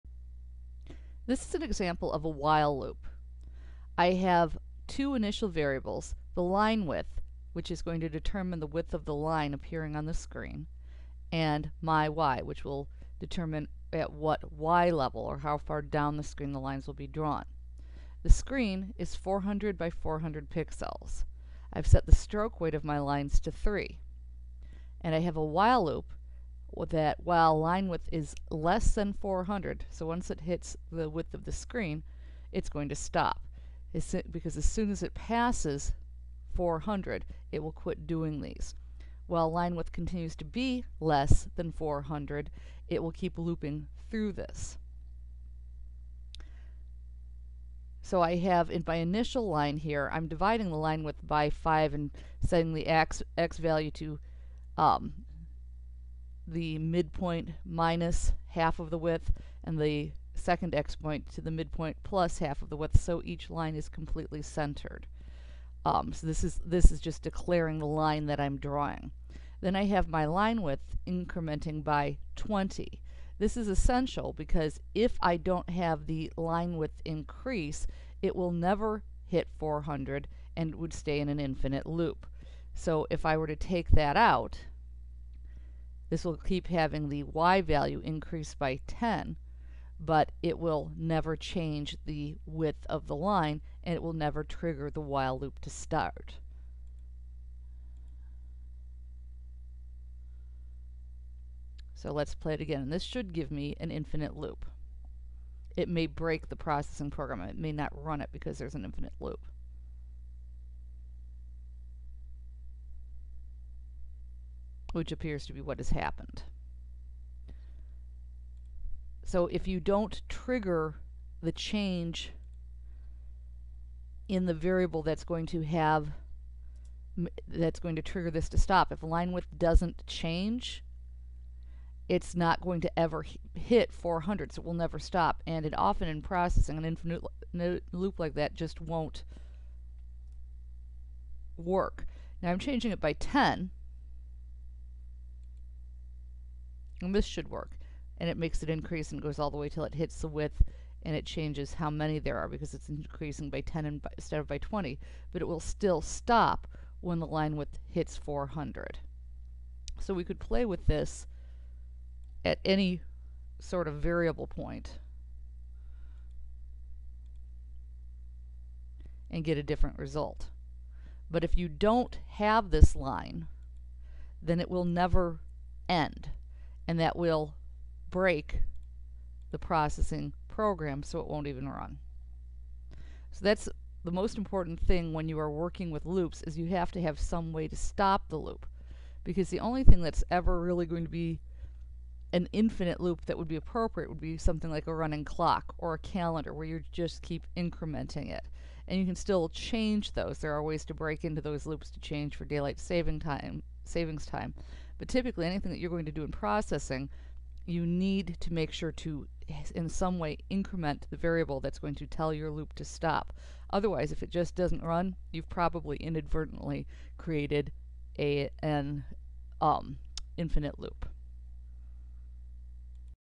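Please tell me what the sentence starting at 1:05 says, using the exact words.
Um, so this is this is just declaring the line that I'm drawing.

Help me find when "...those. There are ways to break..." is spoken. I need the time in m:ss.
3:20.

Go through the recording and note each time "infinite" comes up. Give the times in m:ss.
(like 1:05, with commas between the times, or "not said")
1:21, 1:43, 1:48, 2:16, 3:12, 3:40.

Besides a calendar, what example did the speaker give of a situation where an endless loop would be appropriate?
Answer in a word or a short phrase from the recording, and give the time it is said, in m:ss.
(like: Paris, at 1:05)
A running clock, at 3:14.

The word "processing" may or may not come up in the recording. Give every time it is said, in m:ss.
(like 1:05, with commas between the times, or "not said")
1:46, 2:16, 2:59, 3:26.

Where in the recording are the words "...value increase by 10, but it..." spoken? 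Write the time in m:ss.
1:27.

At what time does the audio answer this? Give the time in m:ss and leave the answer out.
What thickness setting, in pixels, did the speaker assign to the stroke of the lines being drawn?
0:23.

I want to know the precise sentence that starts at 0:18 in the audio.
The screen is 400 by 400 pixels.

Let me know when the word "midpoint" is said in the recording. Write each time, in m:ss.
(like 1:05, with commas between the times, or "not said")
0:56, 1:01.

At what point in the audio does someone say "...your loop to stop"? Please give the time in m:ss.
3:32.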